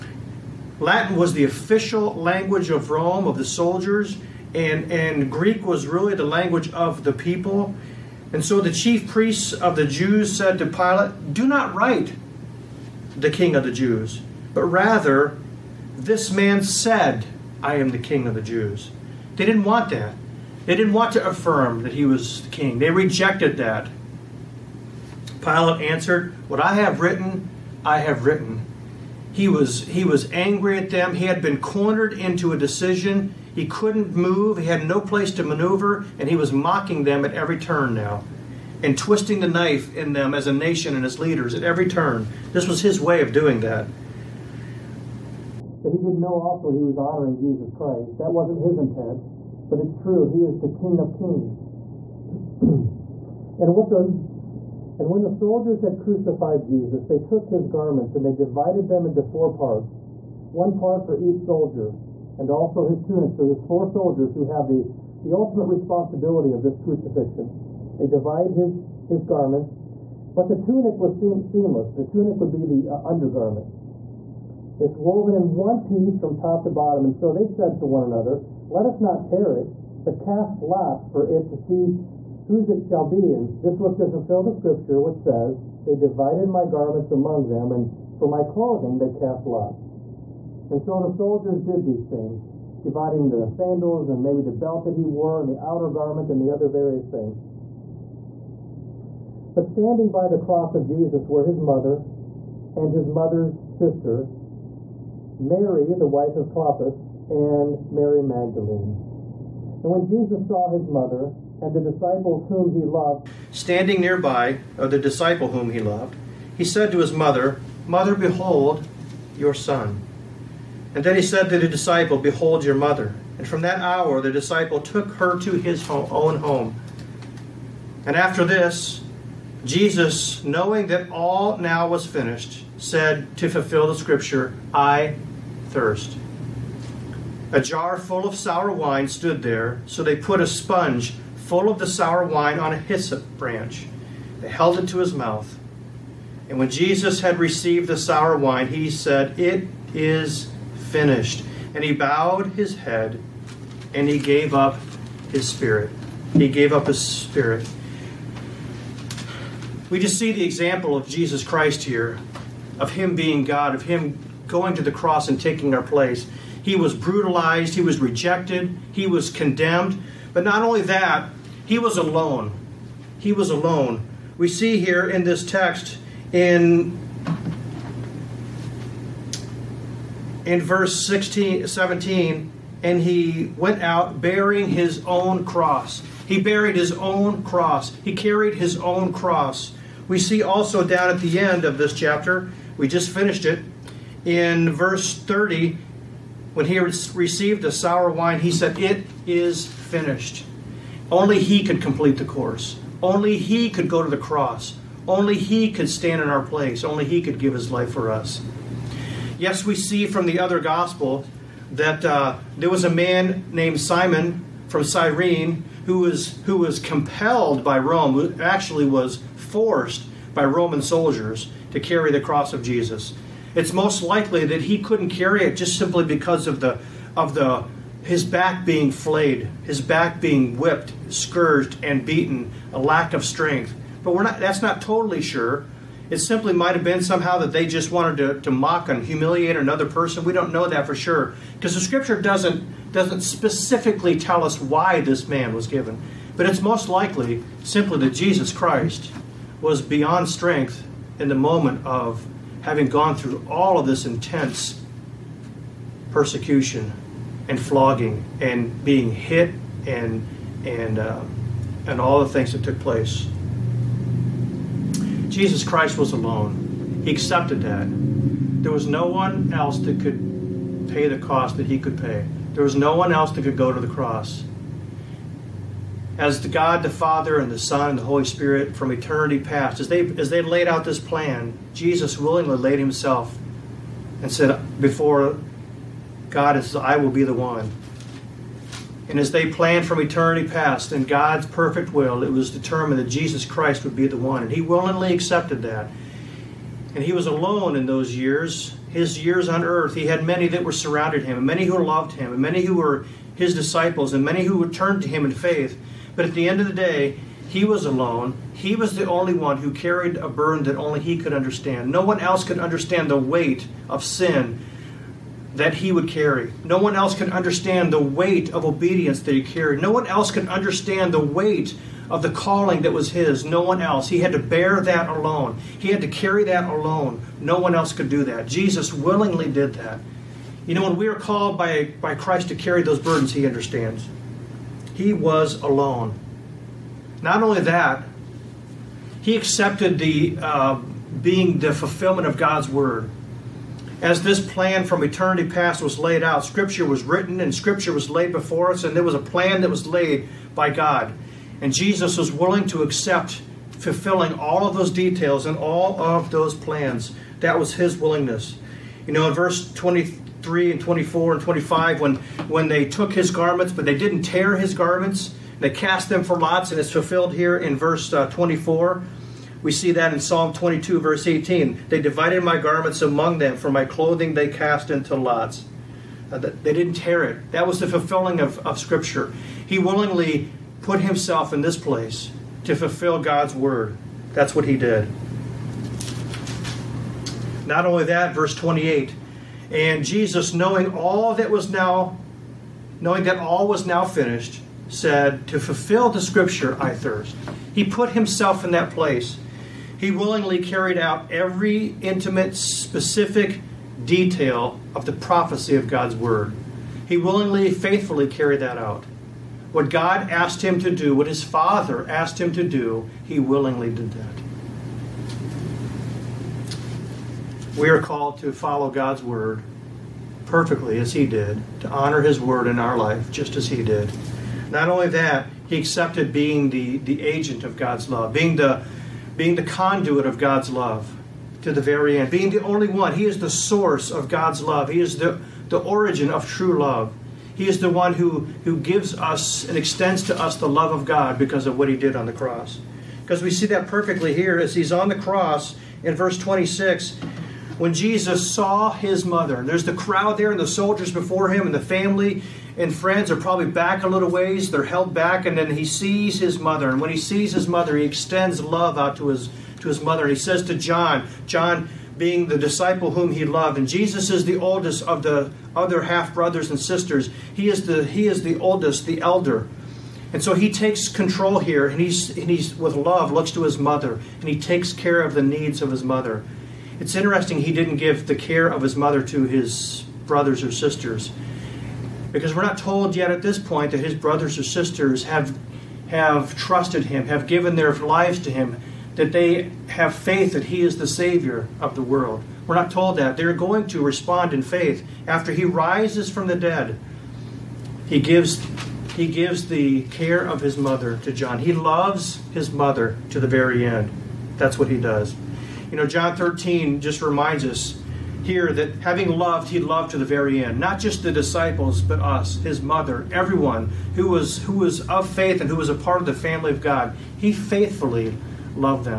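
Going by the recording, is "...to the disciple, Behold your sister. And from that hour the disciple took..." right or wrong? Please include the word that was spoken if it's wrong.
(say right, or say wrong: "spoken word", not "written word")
wrong: "mother", not "sister".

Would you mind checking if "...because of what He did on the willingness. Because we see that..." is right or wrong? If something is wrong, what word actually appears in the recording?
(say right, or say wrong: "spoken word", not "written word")
wrong: "cross", not "willingness".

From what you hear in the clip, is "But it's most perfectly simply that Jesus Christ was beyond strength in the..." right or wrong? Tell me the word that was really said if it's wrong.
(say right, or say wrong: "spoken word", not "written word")
wrong: "likely", not "perfectly".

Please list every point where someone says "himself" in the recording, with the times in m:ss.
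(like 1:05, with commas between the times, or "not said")
4:42, 6:21, 6:38.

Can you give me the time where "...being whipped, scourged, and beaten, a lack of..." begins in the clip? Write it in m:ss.
3:50.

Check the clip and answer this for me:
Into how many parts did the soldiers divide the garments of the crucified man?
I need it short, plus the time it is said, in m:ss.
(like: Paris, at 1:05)
4, at 0:59.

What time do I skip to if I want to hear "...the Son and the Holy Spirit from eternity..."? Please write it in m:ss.
4:37.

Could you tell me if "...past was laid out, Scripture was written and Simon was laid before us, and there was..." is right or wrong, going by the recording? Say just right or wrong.
wrong.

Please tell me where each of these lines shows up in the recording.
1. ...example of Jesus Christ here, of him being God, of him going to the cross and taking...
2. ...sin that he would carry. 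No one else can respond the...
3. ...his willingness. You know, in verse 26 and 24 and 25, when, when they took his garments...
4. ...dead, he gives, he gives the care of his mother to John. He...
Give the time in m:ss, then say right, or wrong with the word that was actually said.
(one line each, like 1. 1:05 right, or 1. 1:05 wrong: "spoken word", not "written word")
1. 2:40 right
2. 5:14 wrong: "understand", not "respond"
3. 5:57 wrong: "23", not "26"
4. 8:16 right.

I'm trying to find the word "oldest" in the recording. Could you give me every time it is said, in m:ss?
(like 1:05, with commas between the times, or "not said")
7:44, 7:48.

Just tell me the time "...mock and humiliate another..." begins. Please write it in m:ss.
3:58.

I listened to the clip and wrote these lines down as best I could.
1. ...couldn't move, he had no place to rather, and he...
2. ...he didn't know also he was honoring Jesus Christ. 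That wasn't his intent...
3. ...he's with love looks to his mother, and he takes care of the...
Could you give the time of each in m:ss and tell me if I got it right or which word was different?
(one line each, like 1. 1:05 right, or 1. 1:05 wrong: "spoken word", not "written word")
1. 0:33 wrong: "maneuver", not "rather"
2. 0:45 right
3. 7:52 right.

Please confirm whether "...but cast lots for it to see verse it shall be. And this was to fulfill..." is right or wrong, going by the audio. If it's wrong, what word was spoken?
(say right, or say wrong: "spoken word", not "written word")
wrong: "whose", not "verse".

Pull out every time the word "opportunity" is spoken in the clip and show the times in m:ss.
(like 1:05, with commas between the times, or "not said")
not said.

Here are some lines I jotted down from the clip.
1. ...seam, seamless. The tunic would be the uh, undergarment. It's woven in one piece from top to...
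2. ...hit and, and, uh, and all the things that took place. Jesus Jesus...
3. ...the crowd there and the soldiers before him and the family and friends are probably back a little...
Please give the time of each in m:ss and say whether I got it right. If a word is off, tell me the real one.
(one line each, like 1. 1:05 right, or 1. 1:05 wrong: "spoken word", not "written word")
1. 1:11 right
2. 4:19 wrong: "Christ", not "Jesus"
3. 7:29 right.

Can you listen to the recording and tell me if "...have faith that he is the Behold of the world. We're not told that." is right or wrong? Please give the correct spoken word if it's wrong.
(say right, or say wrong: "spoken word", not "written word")
wrong: "Savior", not "Behold".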